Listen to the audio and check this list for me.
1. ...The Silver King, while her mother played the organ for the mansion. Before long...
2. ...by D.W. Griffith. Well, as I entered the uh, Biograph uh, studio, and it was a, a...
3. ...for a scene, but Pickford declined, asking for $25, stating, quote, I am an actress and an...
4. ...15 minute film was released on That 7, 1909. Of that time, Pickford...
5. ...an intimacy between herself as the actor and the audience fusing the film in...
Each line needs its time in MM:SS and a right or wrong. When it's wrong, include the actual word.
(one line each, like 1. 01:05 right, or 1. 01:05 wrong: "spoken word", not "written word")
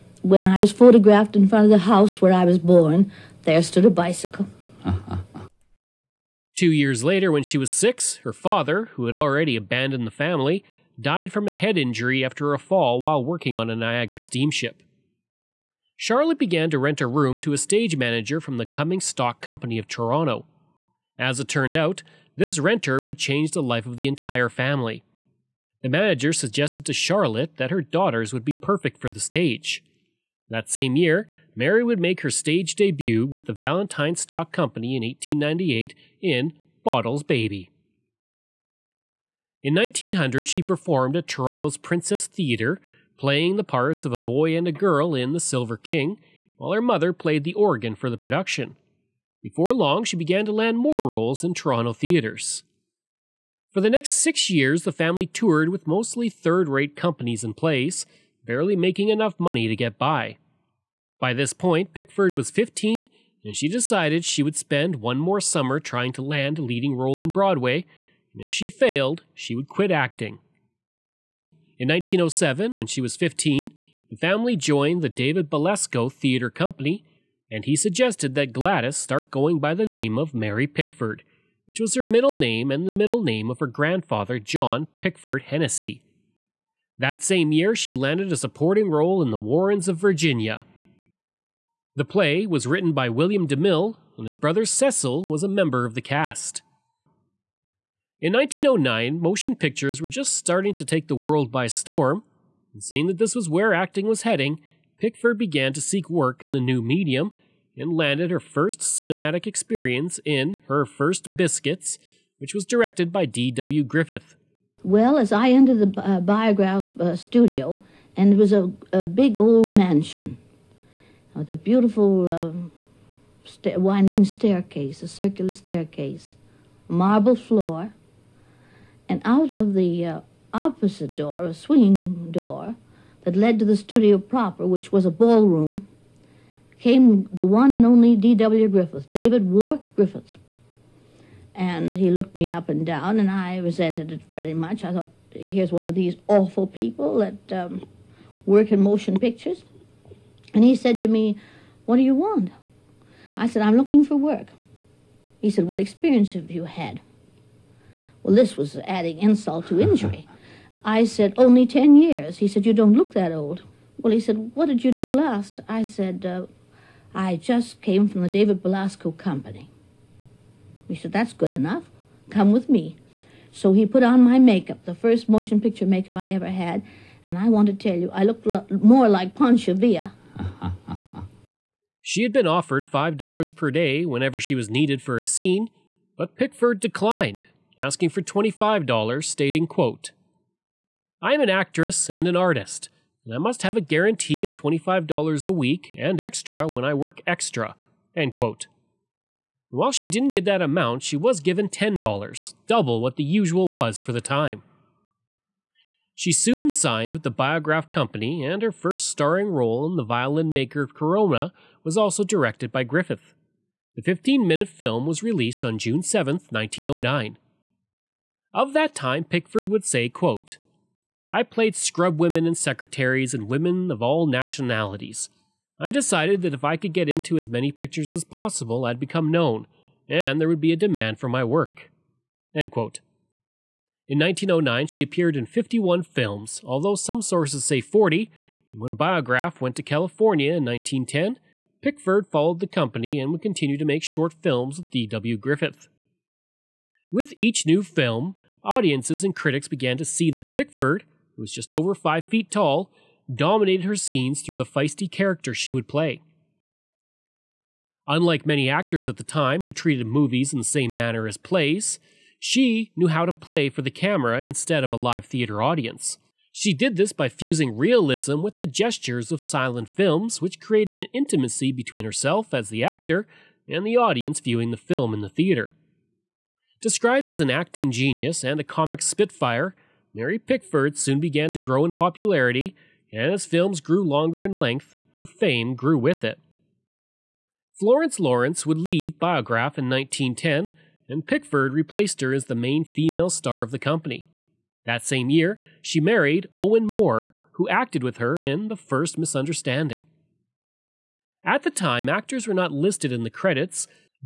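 1. 00:45 wrong: "production", not "mansion"
2. 01:53 right
3. 03:05 right
4. 03:34 wrong: "June", not "That"
5. 04:30 wrong: "viewing", not "fusing".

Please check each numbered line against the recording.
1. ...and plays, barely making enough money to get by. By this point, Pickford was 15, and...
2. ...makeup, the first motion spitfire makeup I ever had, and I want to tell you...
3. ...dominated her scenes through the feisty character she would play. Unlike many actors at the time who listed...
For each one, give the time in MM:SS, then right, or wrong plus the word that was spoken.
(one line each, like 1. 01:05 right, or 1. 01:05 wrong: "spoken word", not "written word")
1. 00:57 right
2. 02:54 wrong: "picture", not "spitfire"
3. 04:13 wrong: "treated", not "listed".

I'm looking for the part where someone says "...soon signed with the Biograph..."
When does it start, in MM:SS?
03:26.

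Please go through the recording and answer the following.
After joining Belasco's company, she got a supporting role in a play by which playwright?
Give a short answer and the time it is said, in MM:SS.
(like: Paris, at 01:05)
William DeMille, at 01:33.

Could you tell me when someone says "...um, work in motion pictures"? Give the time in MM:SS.
02:27.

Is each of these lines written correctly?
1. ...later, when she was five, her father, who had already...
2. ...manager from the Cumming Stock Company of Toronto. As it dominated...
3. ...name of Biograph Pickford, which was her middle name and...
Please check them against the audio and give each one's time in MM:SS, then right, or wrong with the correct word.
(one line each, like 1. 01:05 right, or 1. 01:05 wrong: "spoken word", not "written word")
1. 00:07 wrong: "six", not "five"
2. 00:17 wrong: "turned", not "dominated"
3. 01:19 wrong: "Mary", not "Biograph".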